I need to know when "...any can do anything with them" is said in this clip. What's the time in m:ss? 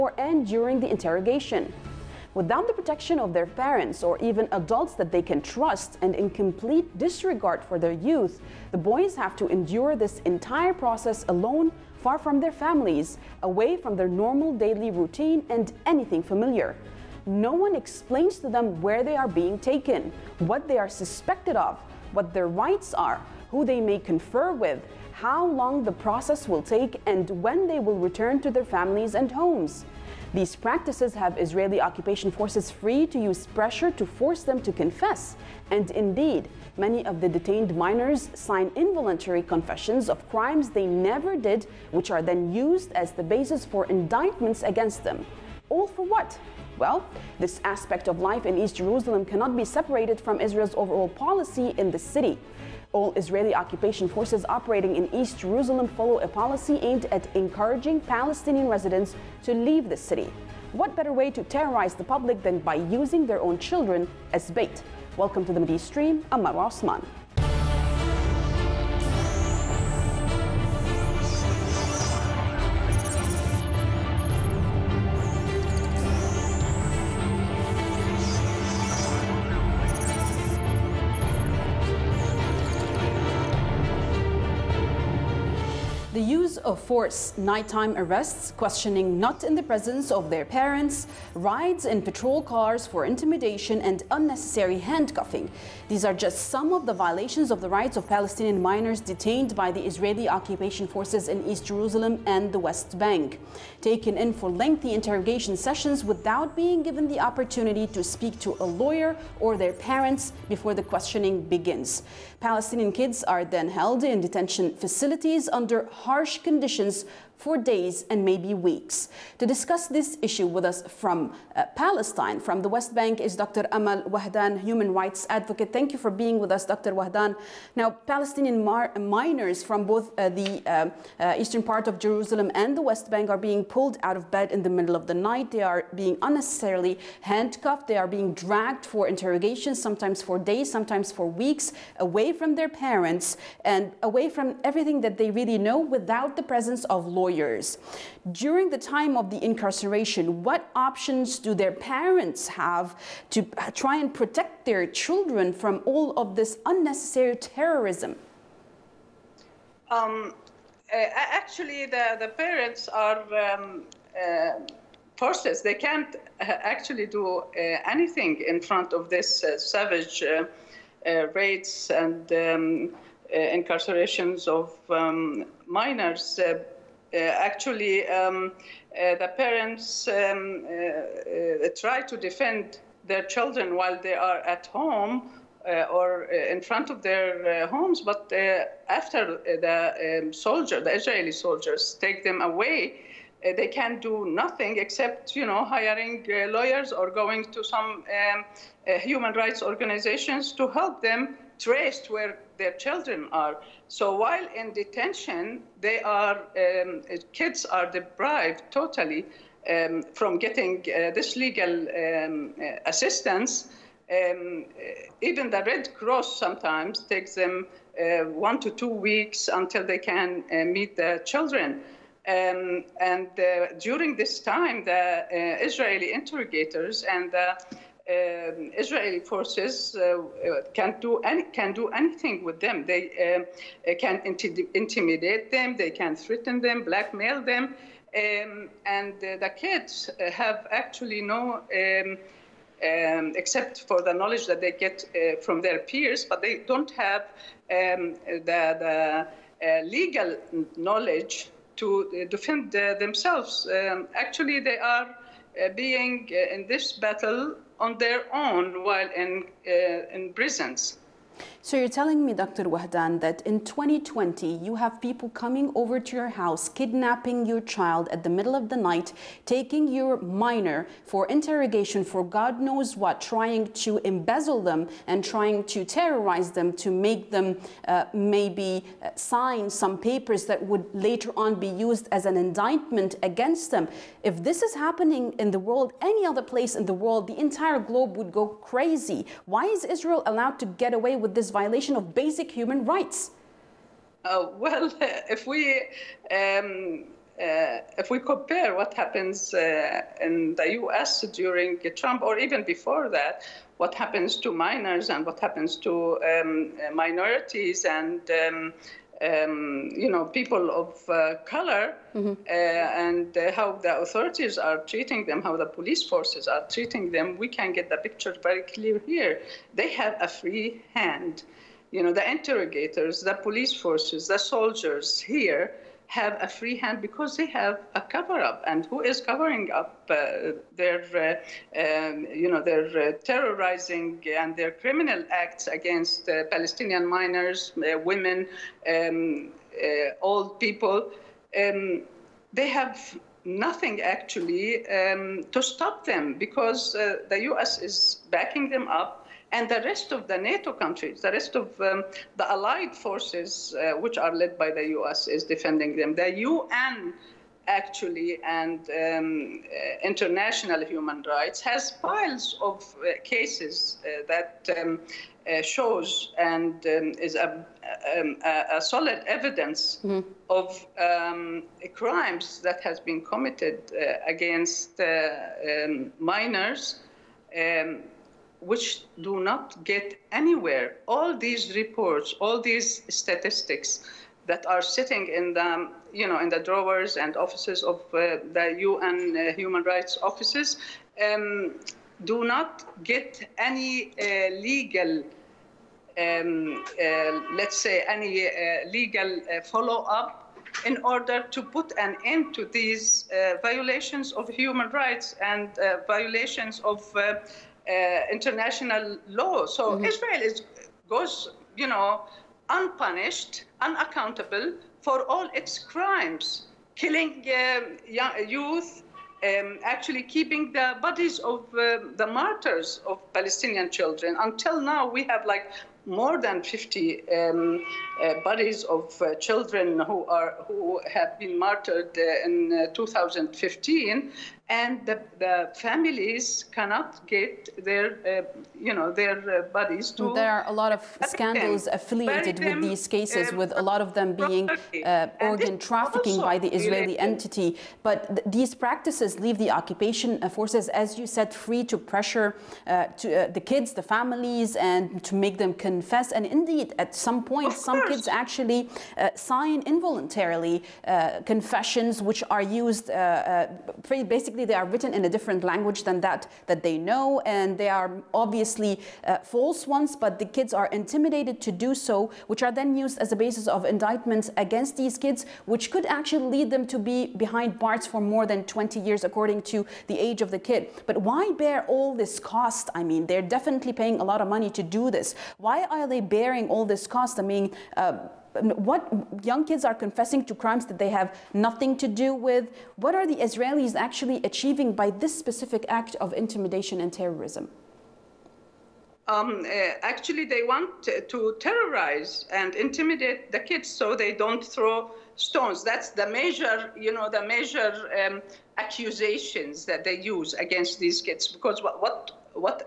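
3:51.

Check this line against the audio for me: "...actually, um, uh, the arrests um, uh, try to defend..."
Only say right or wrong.
wrong.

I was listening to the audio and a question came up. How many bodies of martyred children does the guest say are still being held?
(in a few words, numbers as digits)
more than 50.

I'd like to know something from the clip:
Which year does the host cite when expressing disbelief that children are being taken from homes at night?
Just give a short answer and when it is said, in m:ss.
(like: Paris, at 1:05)
2020, at 4:23.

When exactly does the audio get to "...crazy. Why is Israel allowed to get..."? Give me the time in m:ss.
4:48.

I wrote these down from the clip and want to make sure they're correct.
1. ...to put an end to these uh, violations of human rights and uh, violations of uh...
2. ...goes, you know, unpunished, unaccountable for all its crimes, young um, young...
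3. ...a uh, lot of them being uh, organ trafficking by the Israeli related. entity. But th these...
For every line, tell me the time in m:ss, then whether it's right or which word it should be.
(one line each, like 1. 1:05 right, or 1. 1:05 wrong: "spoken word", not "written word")
1. 6:41 right
2. 6:51 wrong: "killing", not "young"
3. 7:23 right.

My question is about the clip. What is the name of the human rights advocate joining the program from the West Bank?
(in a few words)
Amal Wahdan.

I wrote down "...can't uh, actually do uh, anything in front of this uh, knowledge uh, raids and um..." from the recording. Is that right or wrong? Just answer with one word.
wrong.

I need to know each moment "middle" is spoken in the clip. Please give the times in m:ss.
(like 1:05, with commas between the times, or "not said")
2:14, 4:28.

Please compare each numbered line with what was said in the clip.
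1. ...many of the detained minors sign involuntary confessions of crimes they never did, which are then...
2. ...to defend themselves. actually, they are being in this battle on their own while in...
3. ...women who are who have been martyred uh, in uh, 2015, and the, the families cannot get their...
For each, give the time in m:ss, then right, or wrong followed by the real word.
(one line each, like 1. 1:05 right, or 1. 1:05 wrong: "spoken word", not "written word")
1. 0:36 right
2. 4:11 right
3. 7:09 wrong: "children", not "women".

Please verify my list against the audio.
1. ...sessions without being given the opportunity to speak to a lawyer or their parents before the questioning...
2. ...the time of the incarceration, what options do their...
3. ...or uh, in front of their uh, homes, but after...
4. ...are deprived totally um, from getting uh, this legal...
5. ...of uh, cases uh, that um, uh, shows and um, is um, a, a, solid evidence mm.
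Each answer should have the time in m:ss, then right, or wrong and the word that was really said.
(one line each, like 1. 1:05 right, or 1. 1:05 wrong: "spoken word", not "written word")
1. 1:45 right
2. 2:28 right
3. 3:05 right
4. 3:27 right
5. 6:02 right.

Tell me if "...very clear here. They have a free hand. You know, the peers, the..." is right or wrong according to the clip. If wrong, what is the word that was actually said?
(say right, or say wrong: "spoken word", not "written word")
wrong: "interrogators", not "peers".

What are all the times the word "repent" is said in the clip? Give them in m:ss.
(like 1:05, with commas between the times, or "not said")
not said.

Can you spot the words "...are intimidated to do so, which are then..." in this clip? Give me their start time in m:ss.
7:50.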